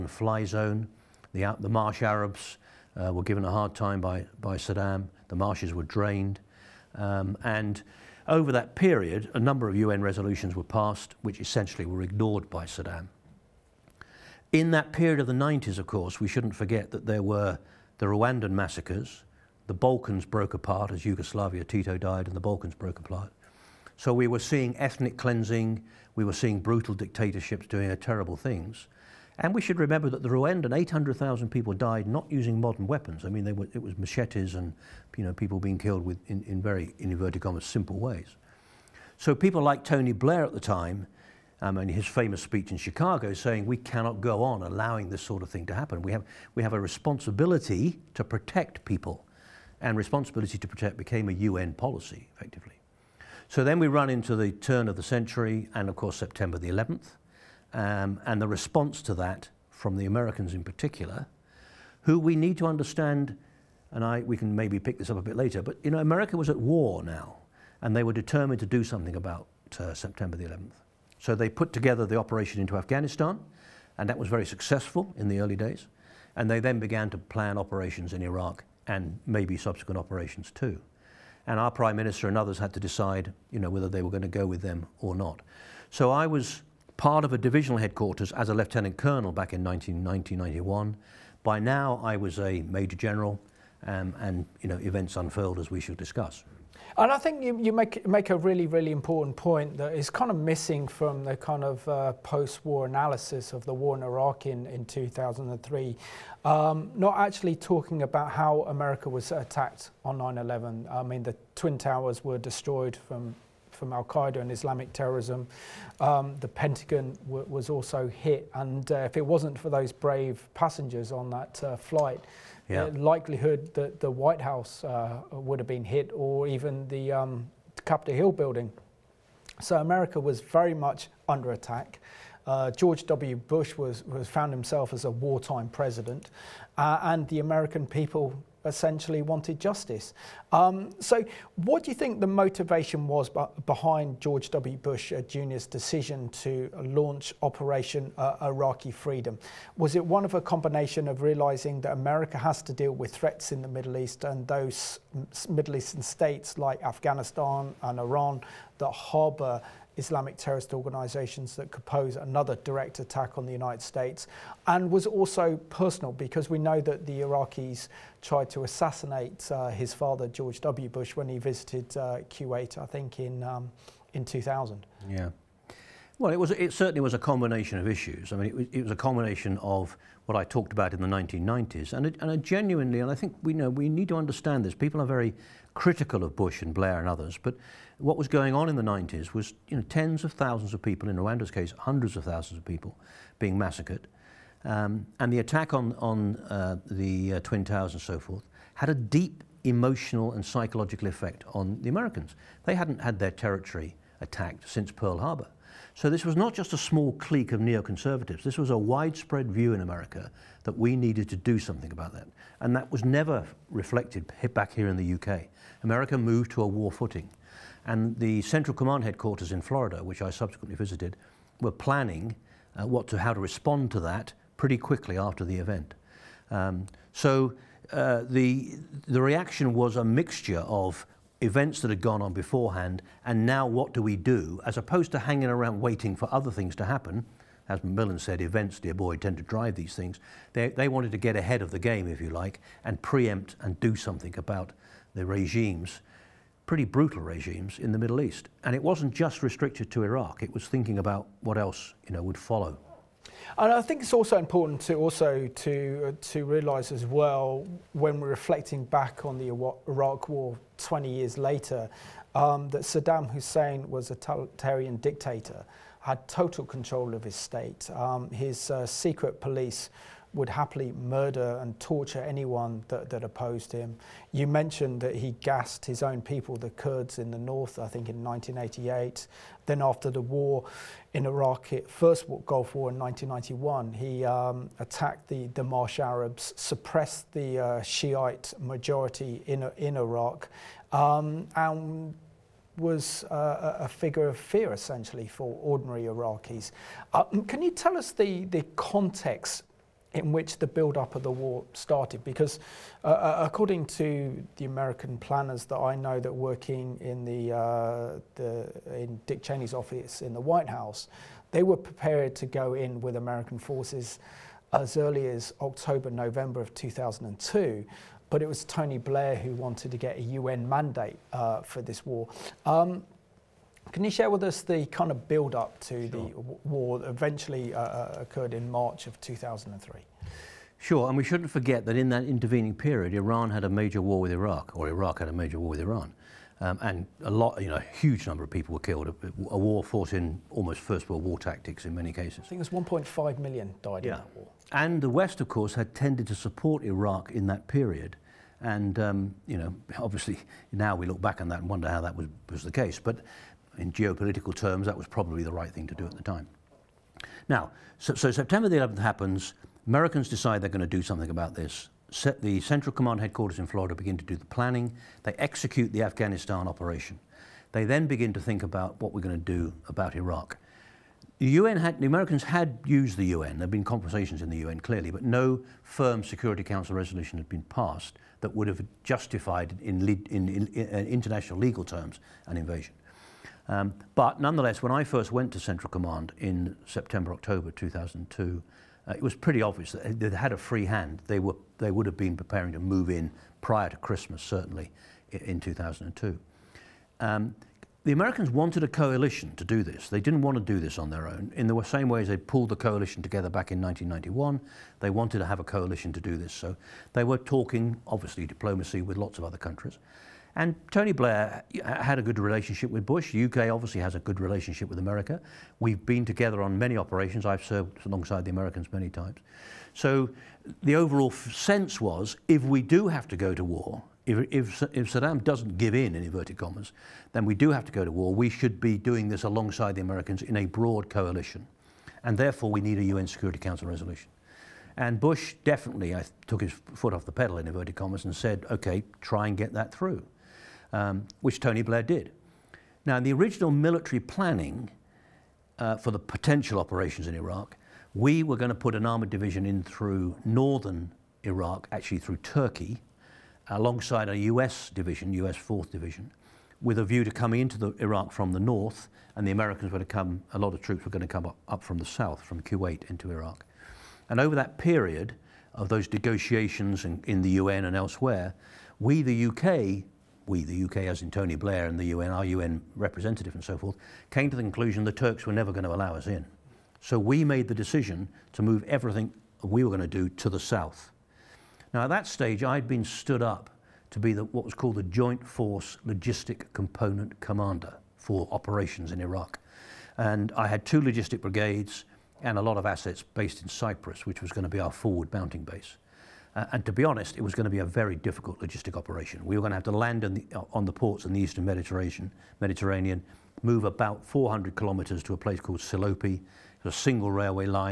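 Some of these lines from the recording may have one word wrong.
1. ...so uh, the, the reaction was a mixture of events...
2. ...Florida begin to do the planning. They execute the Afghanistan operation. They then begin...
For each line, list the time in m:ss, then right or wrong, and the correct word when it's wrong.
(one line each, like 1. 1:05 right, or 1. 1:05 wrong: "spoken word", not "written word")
1. 3:47 right
2. 6:03 right.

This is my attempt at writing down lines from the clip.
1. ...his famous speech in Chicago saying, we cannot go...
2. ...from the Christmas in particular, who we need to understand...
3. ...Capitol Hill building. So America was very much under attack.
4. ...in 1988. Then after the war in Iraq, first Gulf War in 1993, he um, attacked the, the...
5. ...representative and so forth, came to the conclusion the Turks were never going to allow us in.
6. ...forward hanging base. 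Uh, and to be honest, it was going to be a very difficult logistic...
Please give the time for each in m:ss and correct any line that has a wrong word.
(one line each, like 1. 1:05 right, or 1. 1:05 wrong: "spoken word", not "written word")
1. 0:41 right
2. 0:59 wrong: "Americans", not "Christmas"
3. 2:07 right
4. 4:38 wrong: "1991", not "1993"
5. 7:52 right
6. 8:14 wrong: "mounting", not "hanging".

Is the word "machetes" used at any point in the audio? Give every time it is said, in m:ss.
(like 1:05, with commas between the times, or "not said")
0:33.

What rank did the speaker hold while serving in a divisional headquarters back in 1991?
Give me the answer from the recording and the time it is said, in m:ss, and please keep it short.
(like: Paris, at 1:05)
lieutenant colonel, at 1:28.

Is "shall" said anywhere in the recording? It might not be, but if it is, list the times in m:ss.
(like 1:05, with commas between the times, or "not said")
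1:35.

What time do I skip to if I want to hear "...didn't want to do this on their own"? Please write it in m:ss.
6:40.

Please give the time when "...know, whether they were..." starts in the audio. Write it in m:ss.
1:23.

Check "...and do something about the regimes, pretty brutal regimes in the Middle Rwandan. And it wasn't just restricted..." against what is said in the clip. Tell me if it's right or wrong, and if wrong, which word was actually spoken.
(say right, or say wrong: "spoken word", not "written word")
wrong: "East", not "Rwandan".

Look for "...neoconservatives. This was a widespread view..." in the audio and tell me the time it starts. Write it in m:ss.
3:27.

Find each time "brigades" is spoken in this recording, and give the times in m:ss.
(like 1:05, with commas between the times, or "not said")
8:11.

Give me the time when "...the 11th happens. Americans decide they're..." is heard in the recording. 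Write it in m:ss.
5:58.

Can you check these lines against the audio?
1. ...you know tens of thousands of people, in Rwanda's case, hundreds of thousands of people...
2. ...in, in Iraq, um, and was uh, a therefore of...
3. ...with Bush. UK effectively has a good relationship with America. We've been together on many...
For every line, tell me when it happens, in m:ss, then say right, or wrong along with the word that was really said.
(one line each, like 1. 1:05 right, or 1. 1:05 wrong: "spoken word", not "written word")
1. 3:09 right
2. 4:49 wrong: "figure", not "therefore"
3. 6:52 wrong: "obviously", not "effectively".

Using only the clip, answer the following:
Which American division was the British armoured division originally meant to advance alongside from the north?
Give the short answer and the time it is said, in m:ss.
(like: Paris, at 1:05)
US 4th Division, at 7:35.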